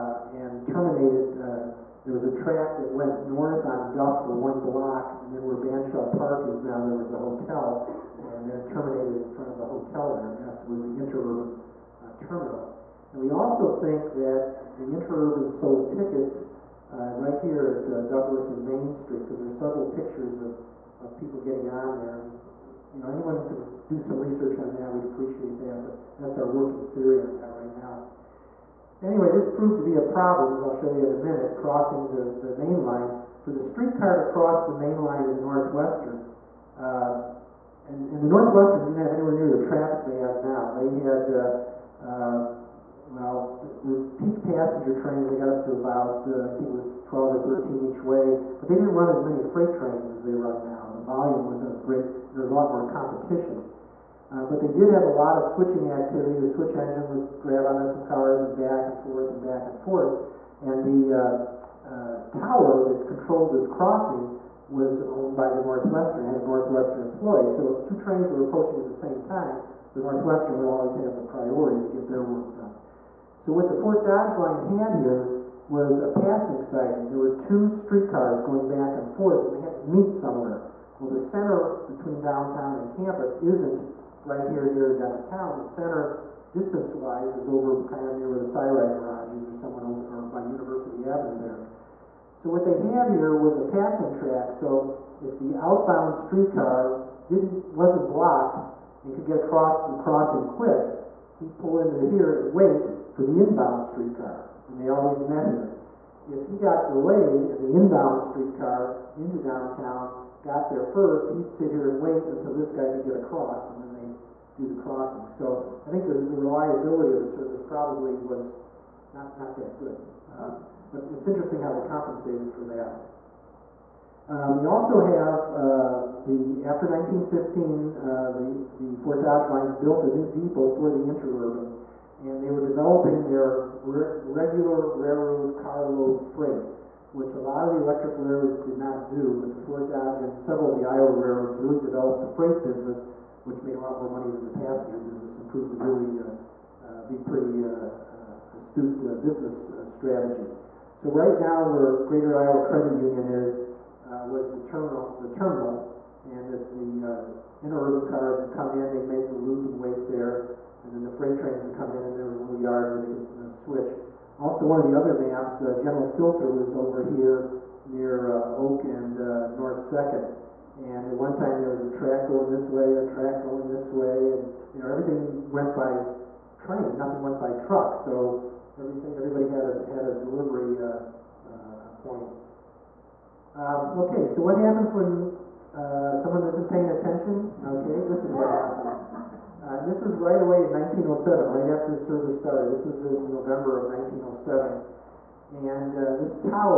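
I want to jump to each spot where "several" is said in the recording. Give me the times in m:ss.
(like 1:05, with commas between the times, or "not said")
0:19, 2:20.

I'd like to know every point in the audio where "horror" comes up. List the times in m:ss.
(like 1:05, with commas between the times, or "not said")
not said.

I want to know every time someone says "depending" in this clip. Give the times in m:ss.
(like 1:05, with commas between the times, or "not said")
not said.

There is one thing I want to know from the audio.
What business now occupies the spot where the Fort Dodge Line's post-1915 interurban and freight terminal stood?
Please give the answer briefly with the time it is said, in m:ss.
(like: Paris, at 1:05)
Greater Iowa Credit Union, at 2:32.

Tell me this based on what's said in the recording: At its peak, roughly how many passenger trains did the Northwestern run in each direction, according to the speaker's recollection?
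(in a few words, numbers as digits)
12 or 13.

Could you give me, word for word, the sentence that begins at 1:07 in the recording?
So if two trains were approaching at the same time, the Northwestern would always have the priority to get their work done.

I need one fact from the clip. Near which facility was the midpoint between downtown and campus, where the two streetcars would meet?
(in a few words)
The CyRide Garage.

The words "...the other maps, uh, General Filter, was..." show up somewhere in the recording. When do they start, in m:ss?
2:44.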